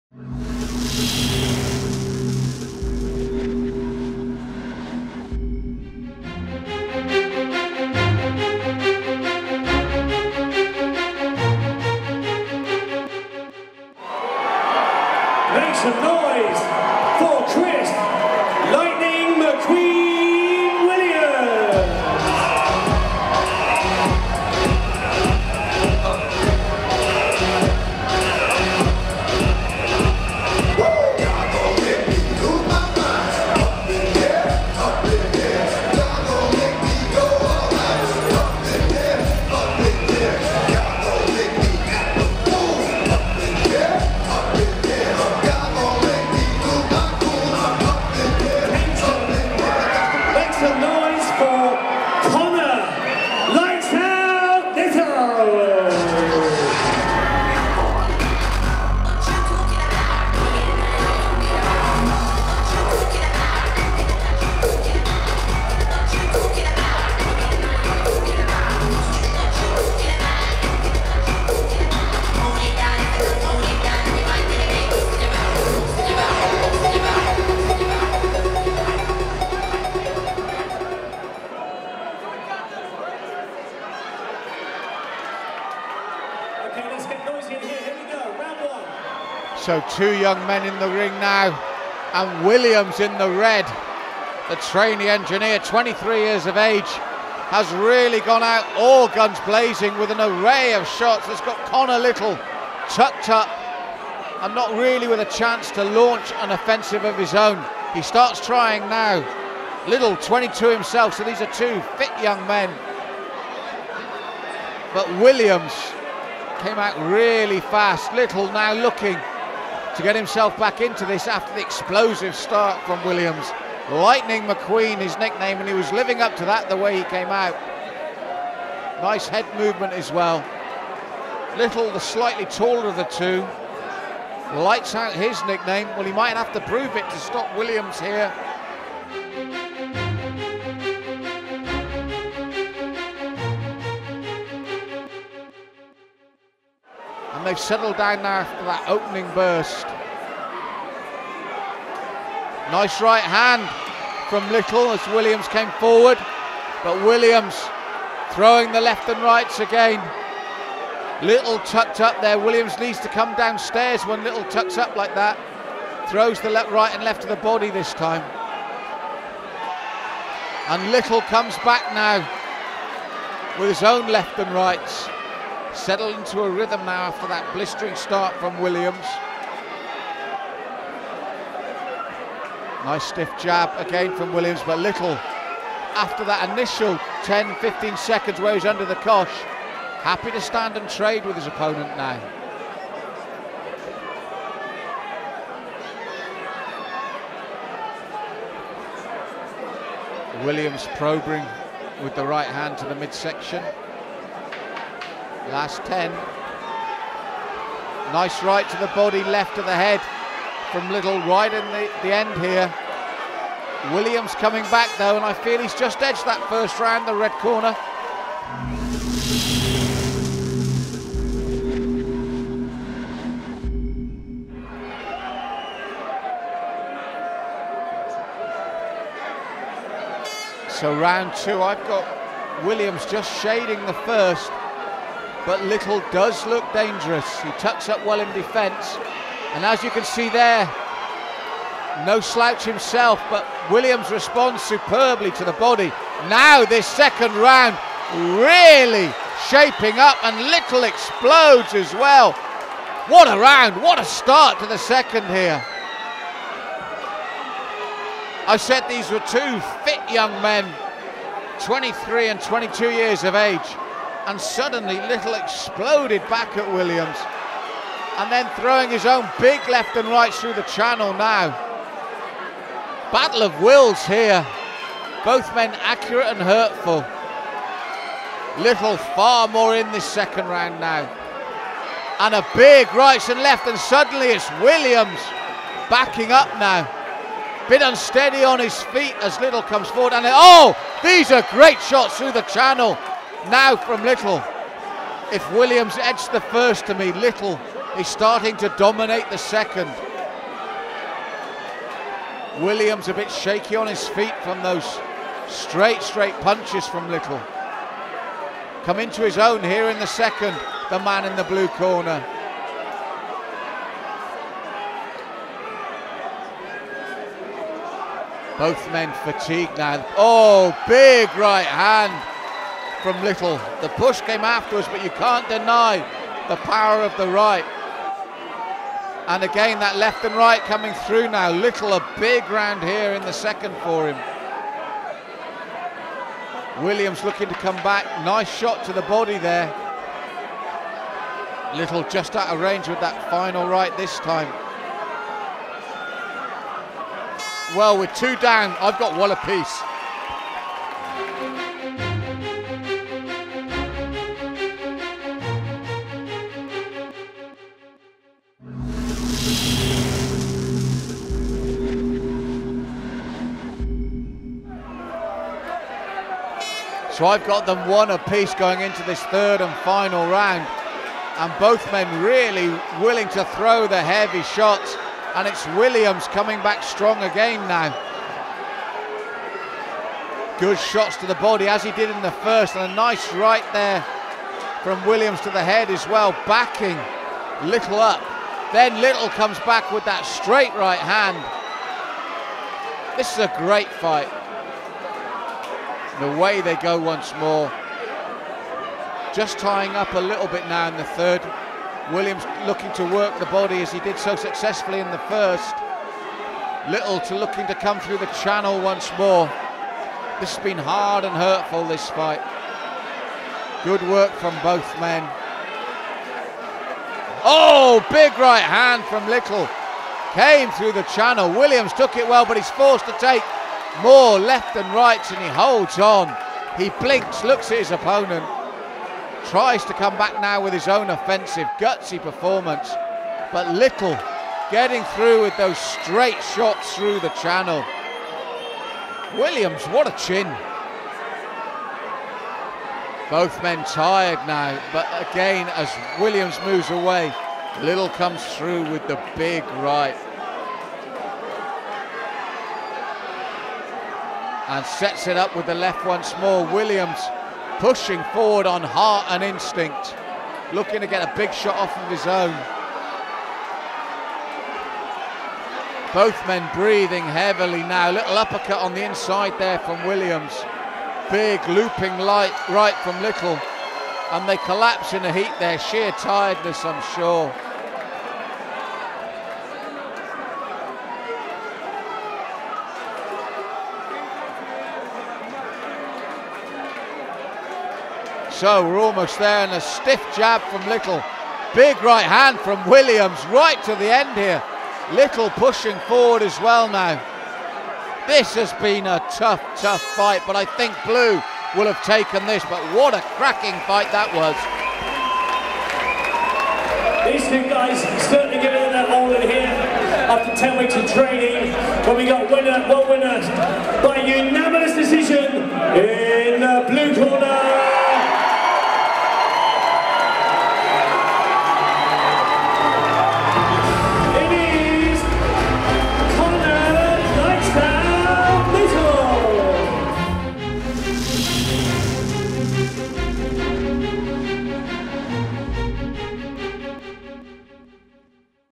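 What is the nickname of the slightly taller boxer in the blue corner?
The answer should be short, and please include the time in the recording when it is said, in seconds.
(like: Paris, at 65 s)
Lights out, at 134 s.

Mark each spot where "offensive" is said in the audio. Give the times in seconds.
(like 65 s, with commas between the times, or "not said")
106 s, 431 s.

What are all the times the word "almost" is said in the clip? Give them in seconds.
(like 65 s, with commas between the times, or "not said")
488 s.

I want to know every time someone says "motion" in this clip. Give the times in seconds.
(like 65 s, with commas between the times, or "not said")
not said.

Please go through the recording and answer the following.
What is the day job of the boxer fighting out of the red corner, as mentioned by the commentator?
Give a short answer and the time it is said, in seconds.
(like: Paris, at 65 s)
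Trainee engineer, at 94 s.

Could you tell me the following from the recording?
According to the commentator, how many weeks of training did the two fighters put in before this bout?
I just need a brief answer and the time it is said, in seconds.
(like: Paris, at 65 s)
10 weeks, at 510 s.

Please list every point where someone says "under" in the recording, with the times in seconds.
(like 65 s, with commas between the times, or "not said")
188 s.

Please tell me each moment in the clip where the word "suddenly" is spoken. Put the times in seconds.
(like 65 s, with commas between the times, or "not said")
264 s, 283 s.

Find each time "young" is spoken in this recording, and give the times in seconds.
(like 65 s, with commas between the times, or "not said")
90 s, 112 s, 260 s.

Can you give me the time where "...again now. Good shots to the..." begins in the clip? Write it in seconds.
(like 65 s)
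377 s.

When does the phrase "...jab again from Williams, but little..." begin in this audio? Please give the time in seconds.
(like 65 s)
183 s.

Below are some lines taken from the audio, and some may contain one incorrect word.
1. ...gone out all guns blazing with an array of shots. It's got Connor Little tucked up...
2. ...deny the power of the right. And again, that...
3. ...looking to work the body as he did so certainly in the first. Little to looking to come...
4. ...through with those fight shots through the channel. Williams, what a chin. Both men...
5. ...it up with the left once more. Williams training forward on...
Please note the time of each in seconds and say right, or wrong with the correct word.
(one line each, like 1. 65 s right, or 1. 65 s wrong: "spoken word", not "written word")
1. 98 s right
2. 325 s right
3. 402 s wrong: "successfully", not "certainly"
4. 435 s wrong: "straight", not "fight"
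5. 455 s wrong: "pushing", not "training".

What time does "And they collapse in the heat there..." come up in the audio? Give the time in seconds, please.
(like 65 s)
474 s.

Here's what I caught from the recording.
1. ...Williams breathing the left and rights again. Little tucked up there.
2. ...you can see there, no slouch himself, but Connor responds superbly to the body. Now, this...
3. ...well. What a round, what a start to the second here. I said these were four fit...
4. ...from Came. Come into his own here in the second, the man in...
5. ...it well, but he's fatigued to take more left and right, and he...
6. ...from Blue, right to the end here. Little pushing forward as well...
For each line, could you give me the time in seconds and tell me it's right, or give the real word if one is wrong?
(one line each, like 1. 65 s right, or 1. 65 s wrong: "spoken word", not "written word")
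1. 157 s wrong: "throwing", not "breathing"
2. 239 s wrong: "Williams", not "Connor"
3. 251 s wrong: "two", not "four"
4. 306 s wrong: "Little", not "Came"
5. 422 s wrong: "forced", not "fatigued"
6. 492 s wrong: "Williams", not "Blue".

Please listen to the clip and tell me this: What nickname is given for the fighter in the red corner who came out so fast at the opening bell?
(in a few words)
Lightning McQueen.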